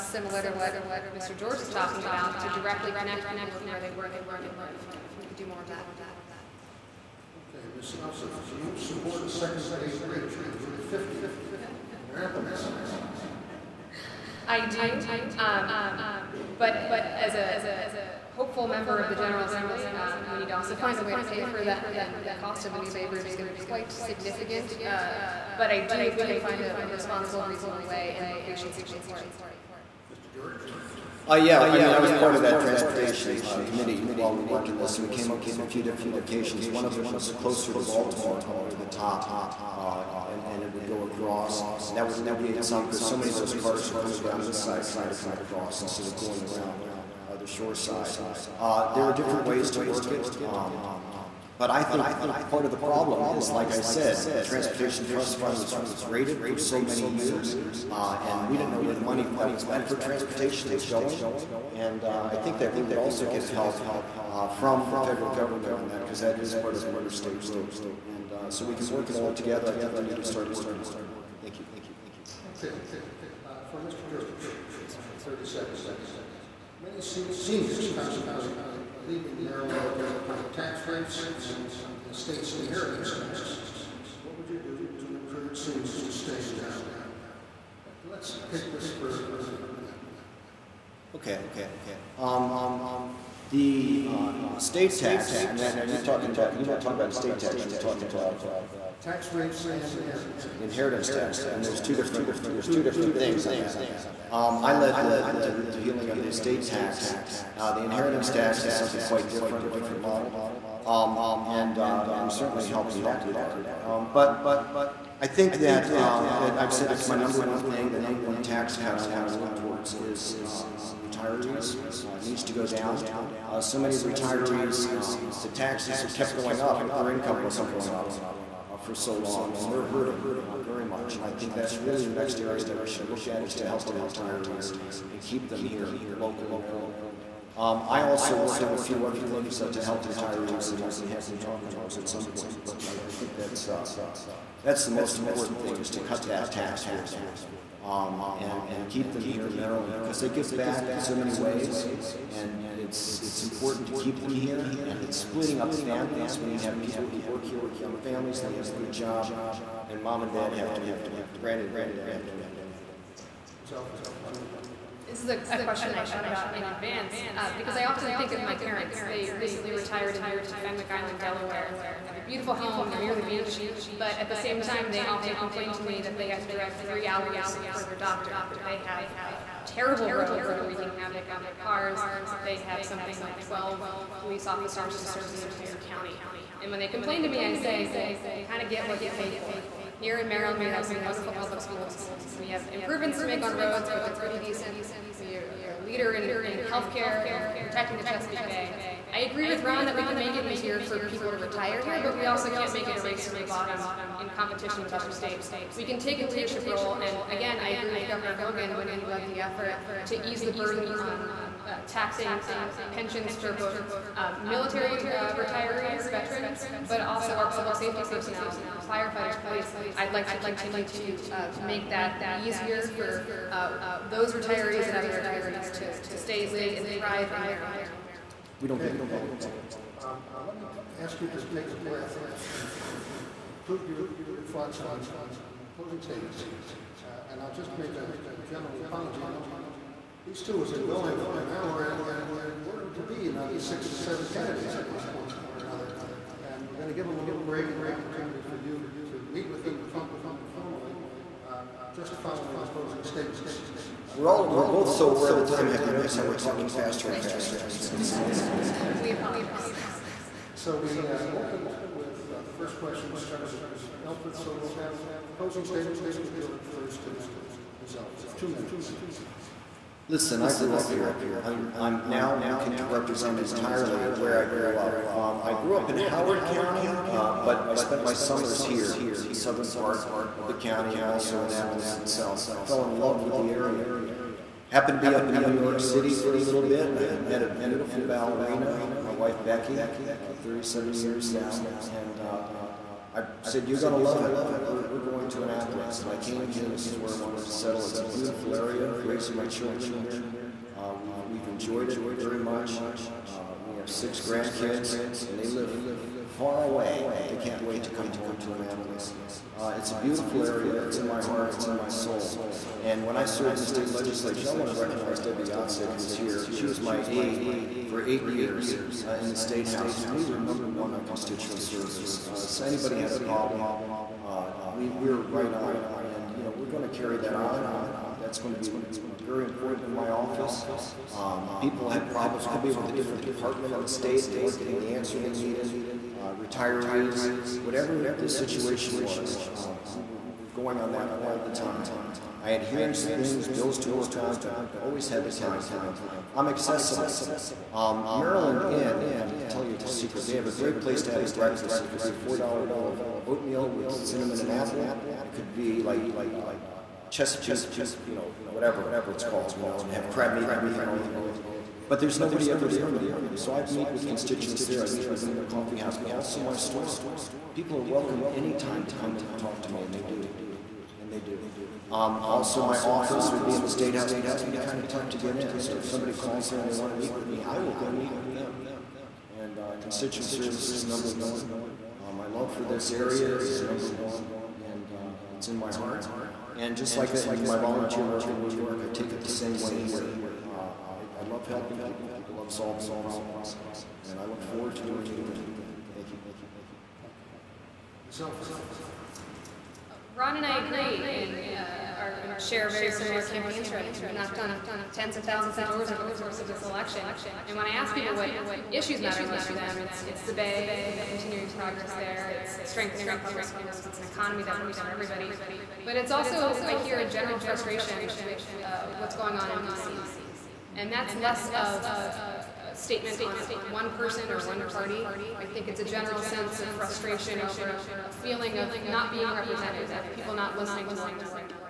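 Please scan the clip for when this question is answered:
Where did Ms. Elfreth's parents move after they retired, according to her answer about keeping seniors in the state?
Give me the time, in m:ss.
2:50.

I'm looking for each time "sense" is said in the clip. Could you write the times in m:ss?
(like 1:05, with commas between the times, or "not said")
7:06.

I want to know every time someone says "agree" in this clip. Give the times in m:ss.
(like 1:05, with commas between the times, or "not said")
3:19, 3:27, 6:40.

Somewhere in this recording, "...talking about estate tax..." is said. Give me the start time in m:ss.
1:36.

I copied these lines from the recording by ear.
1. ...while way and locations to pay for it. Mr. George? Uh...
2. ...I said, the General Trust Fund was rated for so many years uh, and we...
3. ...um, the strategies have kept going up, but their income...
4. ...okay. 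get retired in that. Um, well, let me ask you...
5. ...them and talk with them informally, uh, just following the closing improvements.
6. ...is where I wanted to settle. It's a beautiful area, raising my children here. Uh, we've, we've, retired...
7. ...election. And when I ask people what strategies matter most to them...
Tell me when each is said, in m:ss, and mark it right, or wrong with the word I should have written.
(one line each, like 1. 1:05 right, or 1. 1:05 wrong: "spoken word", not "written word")
1. 0:27 wrong: "reasonable", not "while"
2. 0:53 wrong: "Transportation", not "General"
3. 2:04 wrong: "taxes", not "strategies"
4. 3:48 wrong: "involved", not "retired"
5. 4:09 wrong: "statements", not "improvements"
6. 4:56 wrong: "enjoyed", not "retired"
7. 6:46 wrong: "issues", not "strategies".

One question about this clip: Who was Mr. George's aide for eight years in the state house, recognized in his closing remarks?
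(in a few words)
Debbie Yatsik.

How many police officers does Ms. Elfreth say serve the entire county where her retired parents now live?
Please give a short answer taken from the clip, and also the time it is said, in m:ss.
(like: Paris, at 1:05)
12, at 3:03.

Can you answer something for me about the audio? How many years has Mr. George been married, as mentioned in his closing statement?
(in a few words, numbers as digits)
37.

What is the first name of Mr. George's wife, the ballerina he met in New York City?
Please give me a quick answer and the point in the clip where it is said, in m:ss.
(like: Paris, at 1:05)
Becky, at 4:49.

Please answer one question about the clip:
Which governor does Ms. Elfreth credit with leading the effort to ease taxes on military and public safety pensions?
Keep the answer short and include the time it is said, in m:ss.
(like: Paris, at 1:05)
Governor Hogan, at 3:28.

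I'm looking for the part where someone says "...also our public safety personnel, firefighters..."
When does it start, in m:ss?
3:37.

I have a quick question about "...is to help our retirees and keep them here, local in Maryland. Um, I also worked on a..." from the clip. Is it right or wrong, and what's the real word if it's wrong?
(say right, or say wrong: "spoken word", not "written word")
right.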